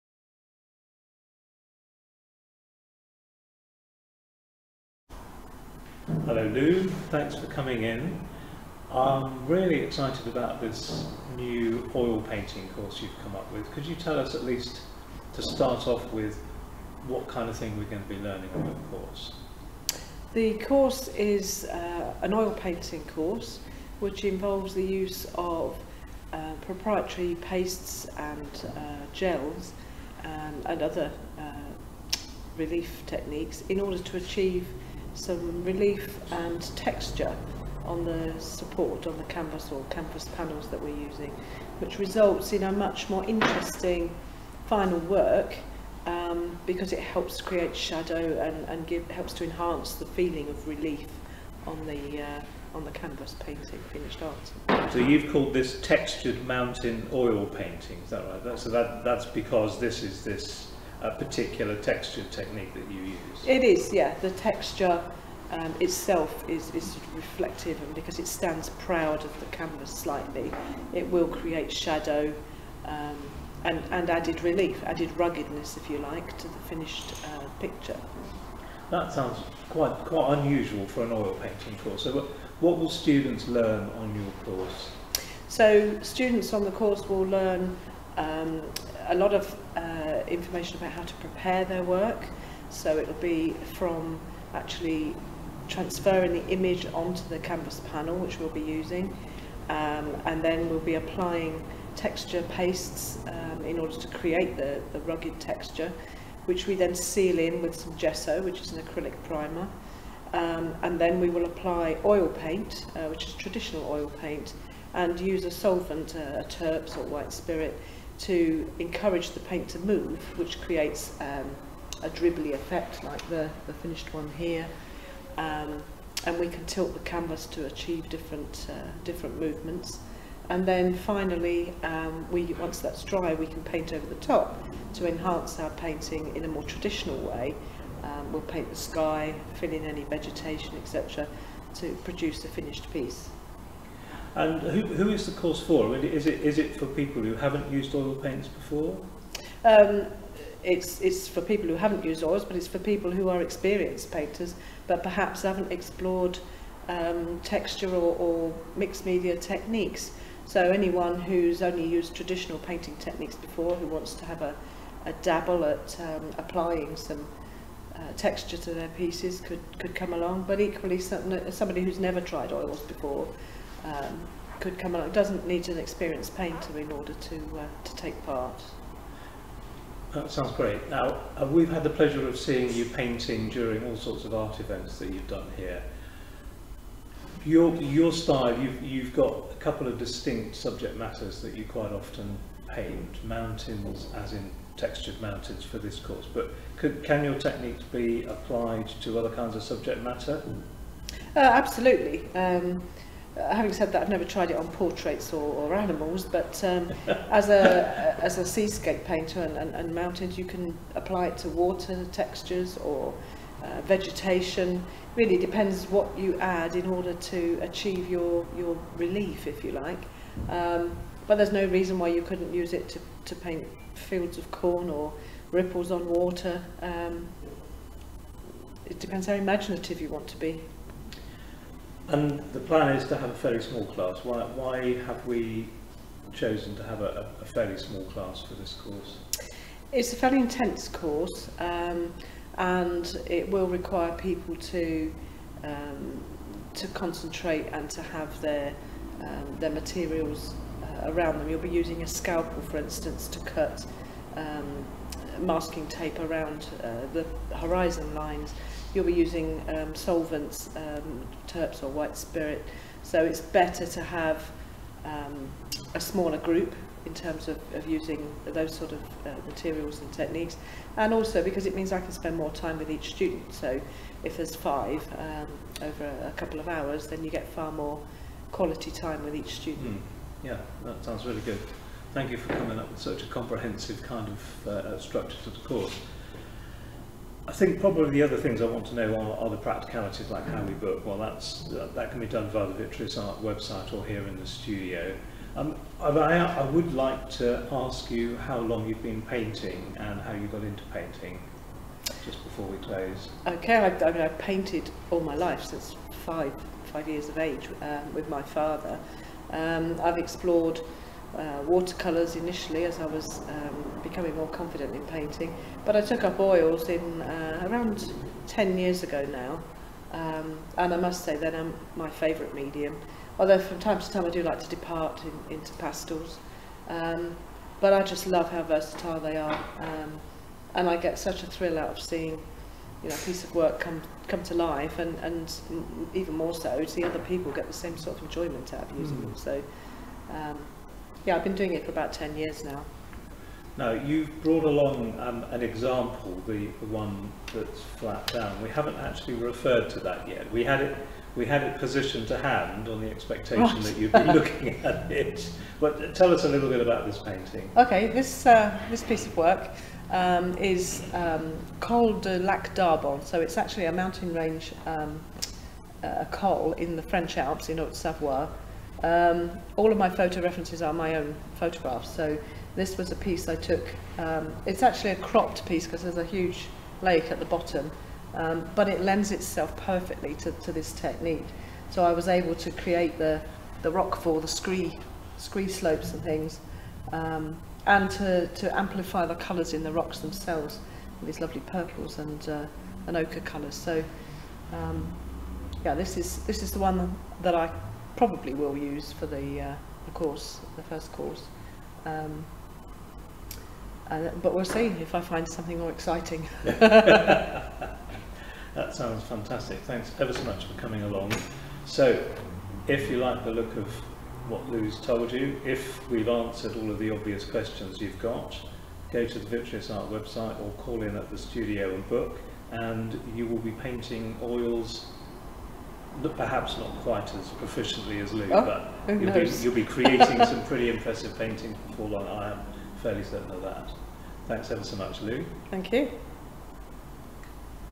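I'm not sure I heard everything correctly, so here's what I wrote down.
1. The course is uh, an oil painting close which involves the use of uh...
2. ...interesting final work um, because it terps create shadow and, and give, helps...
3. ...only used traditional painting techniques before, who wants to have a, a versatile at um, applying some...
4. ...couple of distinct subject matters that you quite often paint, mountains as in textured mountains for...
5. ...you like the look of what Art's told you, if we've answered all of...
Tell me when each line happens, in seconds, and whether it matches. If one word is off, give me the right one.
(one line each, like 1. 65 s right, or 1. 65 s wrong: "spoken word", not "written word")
1. 20 s wrong: "course", not "close"
2. 43 s wrong: "helps", not "terps"
3. 161 s wrong: "dabble", not "versatile"
4. 189 s right
5. 413 s wrong: "Lou", not "Art".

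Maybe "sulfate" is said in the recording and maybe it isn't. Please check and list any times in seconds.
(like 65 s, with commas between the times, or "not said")
not said.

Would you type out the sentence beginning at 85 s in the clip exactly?
So students on the course will learn um, a lot of uh, information about how to prepare their work.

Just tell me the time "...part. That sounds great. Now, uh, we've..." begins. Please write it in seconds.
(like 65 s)
178 s.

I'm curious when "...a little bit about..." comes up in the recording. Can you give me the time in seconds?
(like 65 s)
356 s.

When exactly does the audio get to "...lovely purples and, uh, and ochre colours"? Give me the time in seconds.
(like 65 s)
391 s.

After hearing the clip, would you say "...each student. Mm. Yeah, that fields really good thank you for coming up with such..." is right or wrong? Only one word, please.
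wrong.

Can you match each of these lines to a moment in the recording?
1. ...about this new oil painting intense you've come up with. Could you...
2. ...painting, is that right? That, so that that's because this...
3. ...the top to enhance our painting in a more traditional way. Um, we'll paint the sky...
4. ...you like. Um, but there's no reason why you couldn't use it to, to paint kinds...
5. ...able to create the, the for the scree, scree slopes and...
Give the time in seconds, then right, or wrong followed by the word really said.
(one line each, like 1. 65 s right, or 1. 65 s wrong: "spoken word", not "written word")
1. 10 s wrong: "course", not "intense"
2. 57 s right
3. 134 s right
4. 219 s wrong: "fields", not "kinds"
5. 382 s right.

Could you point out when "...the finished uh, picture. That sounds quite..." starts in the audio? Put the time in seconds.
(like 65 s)
76 s.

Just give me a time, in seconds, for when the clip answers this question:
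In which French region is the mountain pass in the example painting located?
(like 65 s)
367 s.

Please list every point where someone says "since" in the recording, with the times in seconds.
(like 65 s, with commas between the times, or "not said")
305 s.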